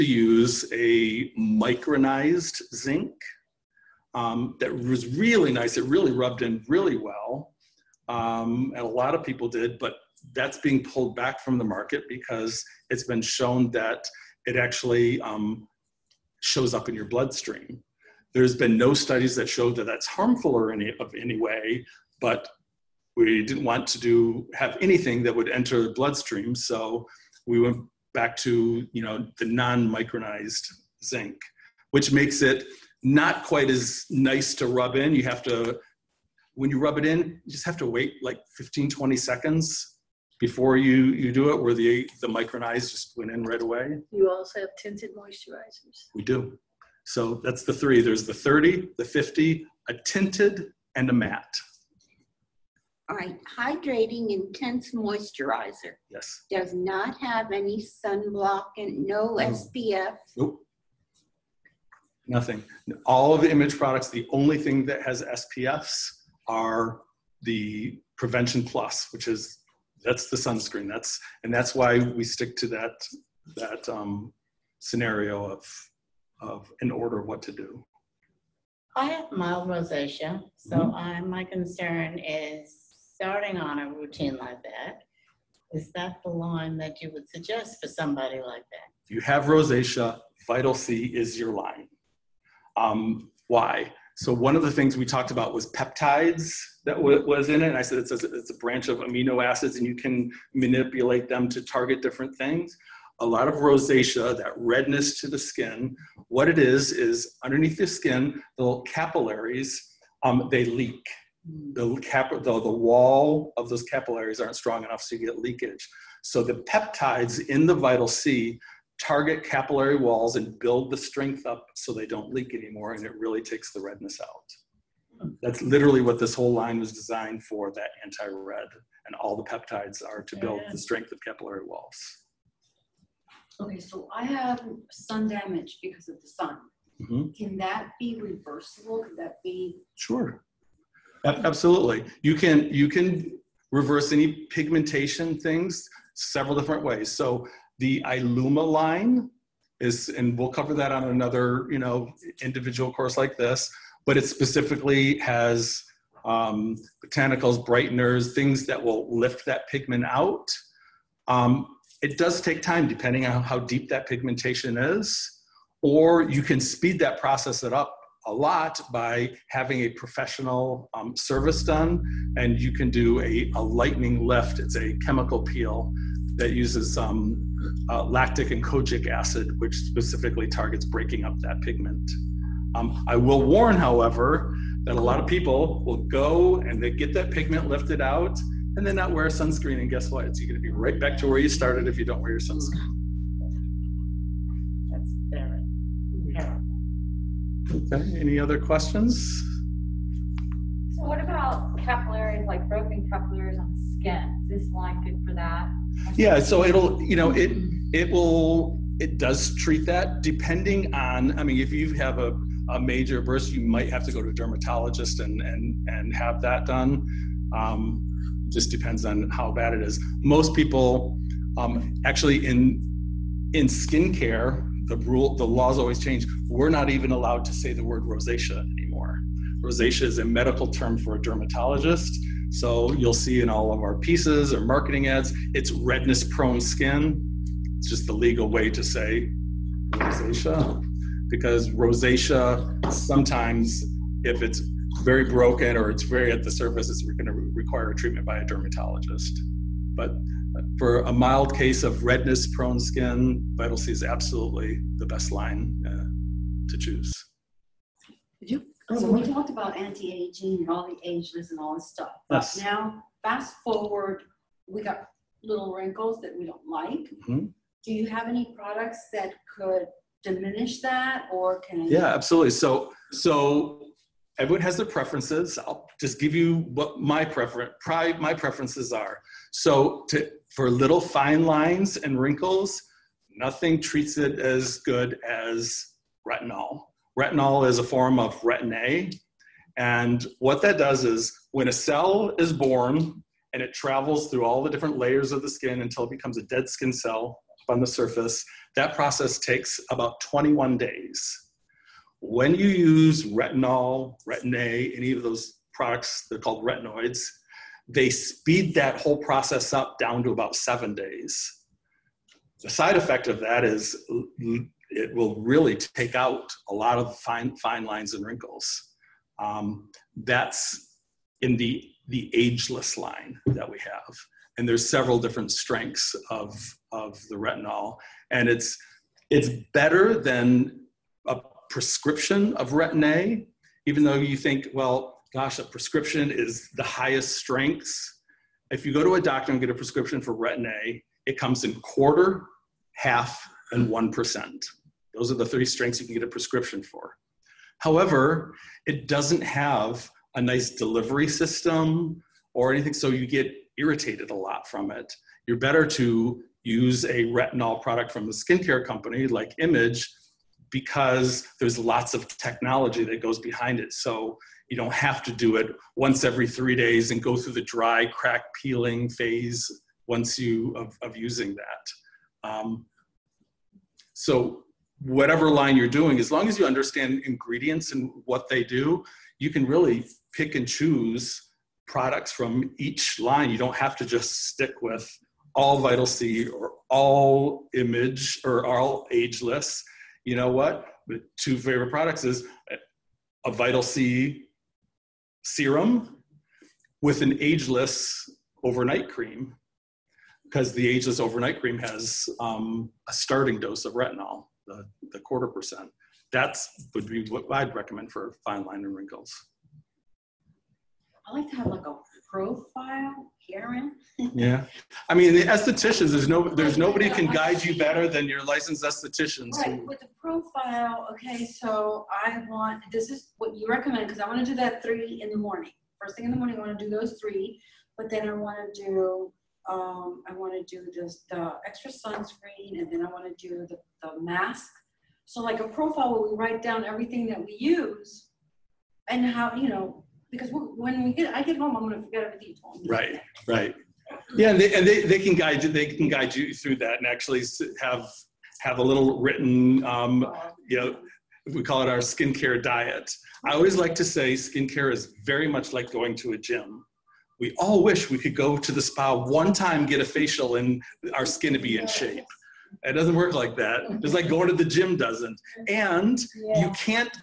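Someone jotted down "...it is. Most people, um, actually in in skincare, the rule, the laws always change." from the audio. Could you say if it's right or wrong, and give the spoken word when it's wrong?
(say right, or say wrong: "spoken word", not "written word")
right.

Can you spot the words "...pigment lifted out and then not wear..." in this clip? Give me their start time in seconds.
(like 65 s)
187 s.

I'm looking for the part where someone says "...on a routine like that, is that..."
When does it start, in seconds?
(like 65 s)
83 s.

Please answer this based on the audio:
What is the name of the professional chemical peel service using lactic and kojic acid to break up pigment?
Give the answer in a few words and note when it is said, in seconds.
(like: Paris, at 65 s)
lightning lift, at 173 s.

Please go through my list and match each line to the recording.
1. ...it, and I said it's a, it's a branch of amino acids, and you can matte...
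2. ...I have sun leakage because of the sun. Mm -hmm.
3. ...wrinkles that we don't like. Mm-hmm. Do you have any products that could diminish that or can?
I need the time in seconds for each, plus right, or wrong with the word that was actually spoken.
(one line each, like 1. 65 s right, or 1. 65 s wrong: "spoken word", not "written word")
1. 97 s wrong: "manipulate", not "matte"
2. 134 s wrong: "damage", not "leakage"
3. 265 s right.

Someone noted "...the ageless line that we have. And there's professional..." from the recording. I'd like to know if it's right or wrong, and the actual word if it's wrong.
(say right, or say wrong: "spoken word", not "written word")
wrong: "several", not "professional".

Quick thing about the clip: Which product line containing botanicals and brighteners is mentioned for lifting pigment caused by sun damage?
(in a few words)
Iluma.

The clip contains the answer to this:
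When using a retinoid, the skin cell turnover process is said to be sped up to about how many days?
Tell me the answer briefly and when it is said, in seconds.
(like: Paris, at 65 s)
7 days, at 310 s.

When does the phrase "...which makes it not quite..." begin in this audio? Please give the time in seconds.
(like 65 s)
31 s.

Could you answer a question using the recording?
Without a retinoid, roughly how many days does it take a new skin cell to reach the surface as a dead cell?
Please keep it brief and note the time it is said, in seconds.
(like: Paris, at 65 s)
21 days, at 300 s.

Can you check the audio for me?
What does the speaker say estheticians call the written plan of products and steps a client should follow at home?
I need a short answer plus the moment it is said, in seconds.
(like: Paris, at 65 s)
skincare diet, at 451 s.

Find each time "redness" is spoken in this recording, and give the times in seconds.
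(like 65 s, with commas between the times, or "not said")
104 s, 123 s, 235 s, 252 s.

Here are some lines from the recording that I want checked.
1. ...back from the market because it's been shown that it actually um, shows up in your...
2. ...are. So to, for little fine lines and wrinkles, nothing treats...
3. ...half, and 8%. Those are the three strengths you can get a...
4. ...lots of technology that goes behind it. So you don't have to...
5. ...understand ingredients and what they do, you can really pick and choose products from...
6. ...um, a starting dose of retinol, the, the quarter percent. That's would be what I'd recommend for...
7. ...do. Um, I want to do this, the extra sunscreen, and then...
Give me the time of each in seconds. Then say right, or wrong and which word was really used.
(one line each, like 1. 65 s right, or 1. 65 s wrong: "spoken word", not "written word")
1. 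11 s right
2. 278 s right
3. 342 s wrong: "1", not "8"
4. 361 s right
5. 376 s right
6. 402 s right
7. 428 s right.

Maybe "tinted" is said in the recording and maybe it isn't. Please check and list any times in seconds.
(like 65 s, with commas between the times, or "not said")
44 s, 50 s.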